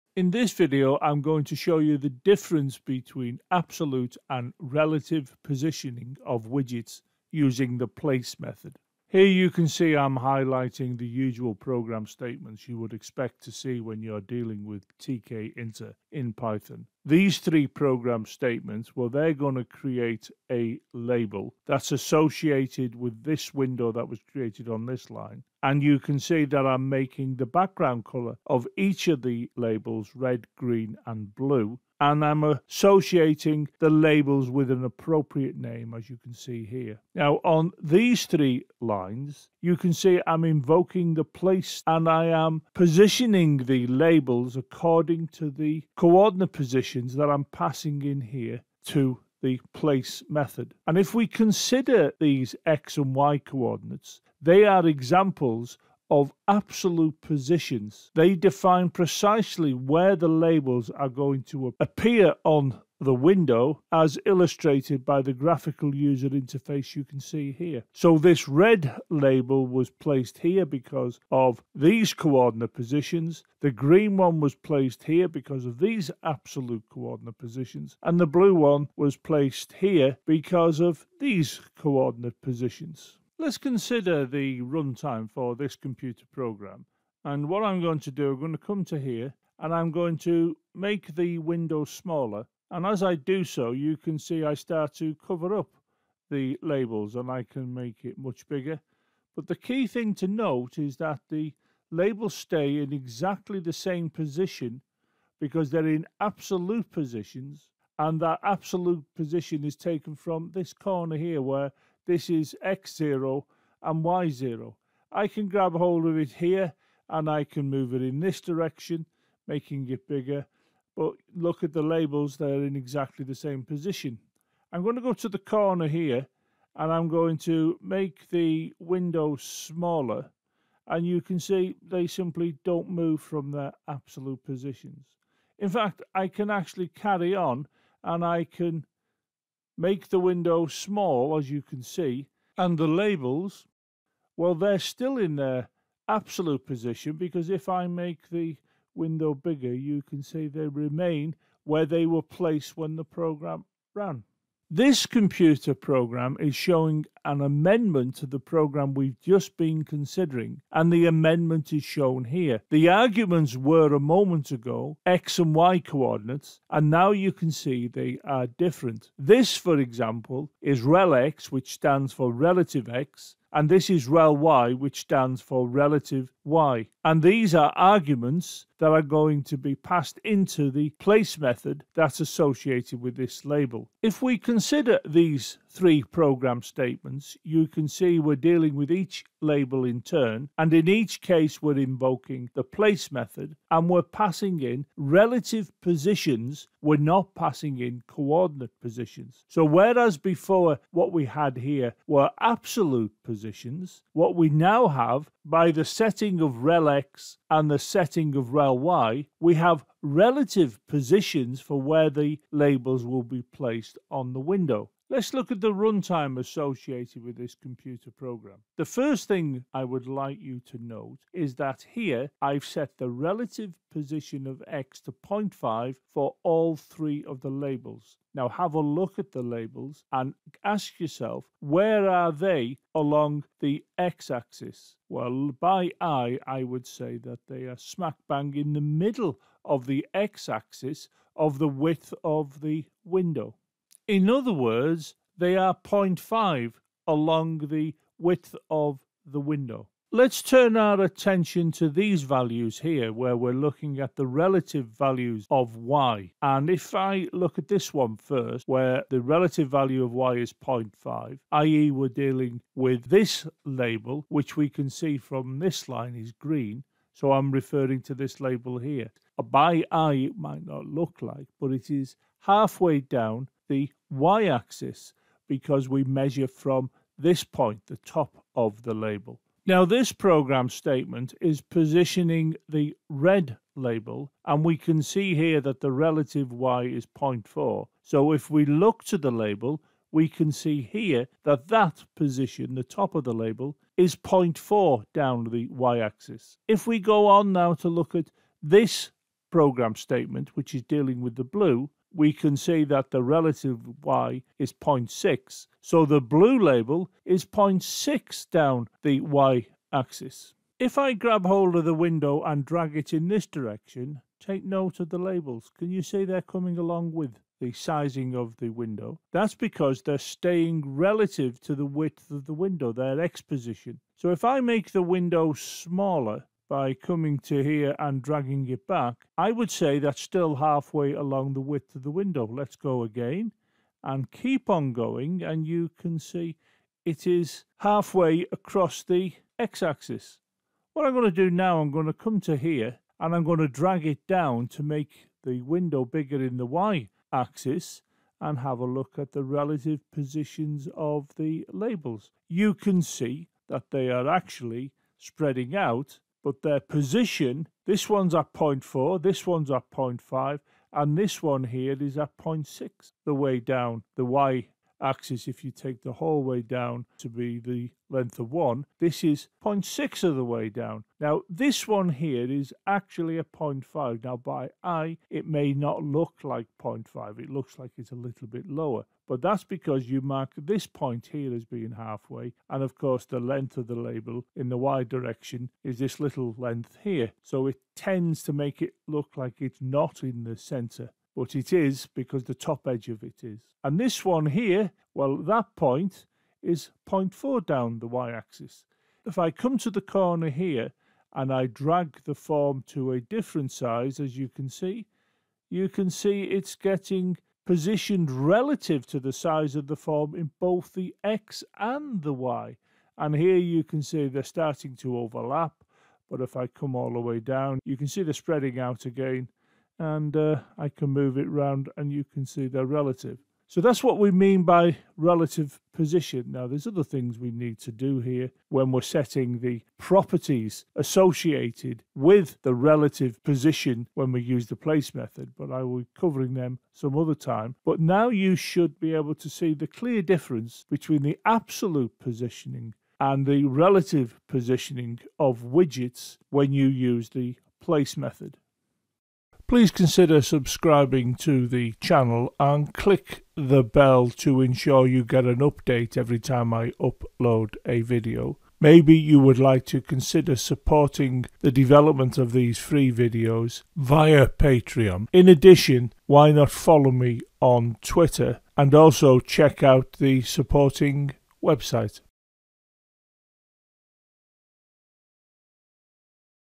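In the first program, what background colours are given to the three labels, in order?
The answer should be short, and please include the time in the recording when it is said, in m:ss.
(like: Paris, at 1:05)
red, green, and blue, at 0:30.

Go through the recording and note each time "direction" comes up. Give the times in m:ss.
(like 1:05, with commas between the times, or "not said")
1:58, 5:13, 6:25.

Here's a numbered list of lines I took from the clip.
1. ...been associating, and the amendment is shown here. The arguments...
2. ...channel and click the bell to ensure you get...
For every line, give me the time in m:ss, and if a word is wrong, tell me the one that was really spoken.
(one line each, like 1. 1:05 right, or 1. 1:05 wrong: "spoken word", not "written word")
1. 2:39 wrong: "considering", not "associating"
2. 7:32 right.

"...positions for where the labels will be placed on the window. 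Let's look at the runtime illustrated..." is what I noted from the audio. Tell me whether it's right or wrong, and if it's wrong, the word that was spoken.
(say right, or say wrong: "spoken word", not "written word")
wrong: "associated", not "illustrated".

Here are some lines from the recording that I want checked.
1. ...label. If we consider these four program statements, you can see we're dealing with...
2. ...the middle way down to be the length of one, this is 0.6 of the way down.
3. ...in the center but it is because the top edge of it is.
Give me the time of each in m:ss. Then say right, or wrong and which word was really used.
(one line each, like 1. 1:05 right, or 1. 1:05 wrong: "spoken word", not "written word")
1. 3:03 wrong: "three", not "four"
2. 6:06 wrong: "whole", not "middle"
3. 6:30 right.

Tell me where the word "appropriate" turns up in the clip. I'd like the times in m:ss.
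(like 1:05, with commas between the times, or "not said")
0:34.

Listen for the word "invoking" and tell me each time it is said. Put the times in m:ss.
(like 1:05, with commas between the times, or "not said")
0:40, 3:11.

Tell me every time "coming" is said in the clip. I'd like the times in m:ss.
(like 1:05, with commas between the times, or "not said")
5:16, 5:26.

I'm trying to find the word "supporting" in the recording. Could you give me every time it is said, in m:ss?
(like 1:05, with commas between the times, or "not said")
7:40, 7:50.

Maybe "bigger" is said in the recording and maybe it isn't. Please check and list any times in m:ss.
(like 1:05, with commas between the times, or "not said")
1:38, 2:00, 2:29, 5:46.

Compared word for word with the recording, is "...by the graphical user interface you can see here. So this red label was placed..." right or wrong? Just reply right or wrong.
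right.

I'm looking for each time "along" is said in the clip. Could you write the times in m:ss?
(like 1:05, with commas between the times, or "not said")
3:52, 4:07, 5:16, 5:31.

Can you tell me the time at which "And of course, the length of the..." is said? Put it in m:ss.
6:22.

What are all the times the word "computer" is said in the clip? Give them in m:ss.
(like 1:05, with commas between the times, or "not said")
1:25, 2:35, 3:37.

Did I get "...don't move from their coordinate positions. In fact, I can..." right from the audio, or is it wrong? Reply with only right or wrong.
wrong.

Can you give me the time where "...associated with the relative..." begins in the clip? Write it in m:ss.
7:10.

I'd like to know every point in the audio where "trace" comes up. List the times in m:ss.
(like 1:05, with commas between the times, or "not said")
not said.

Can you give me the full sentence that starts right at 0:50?
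And if we consider these x and y coordinates, they are examples of absolute positions.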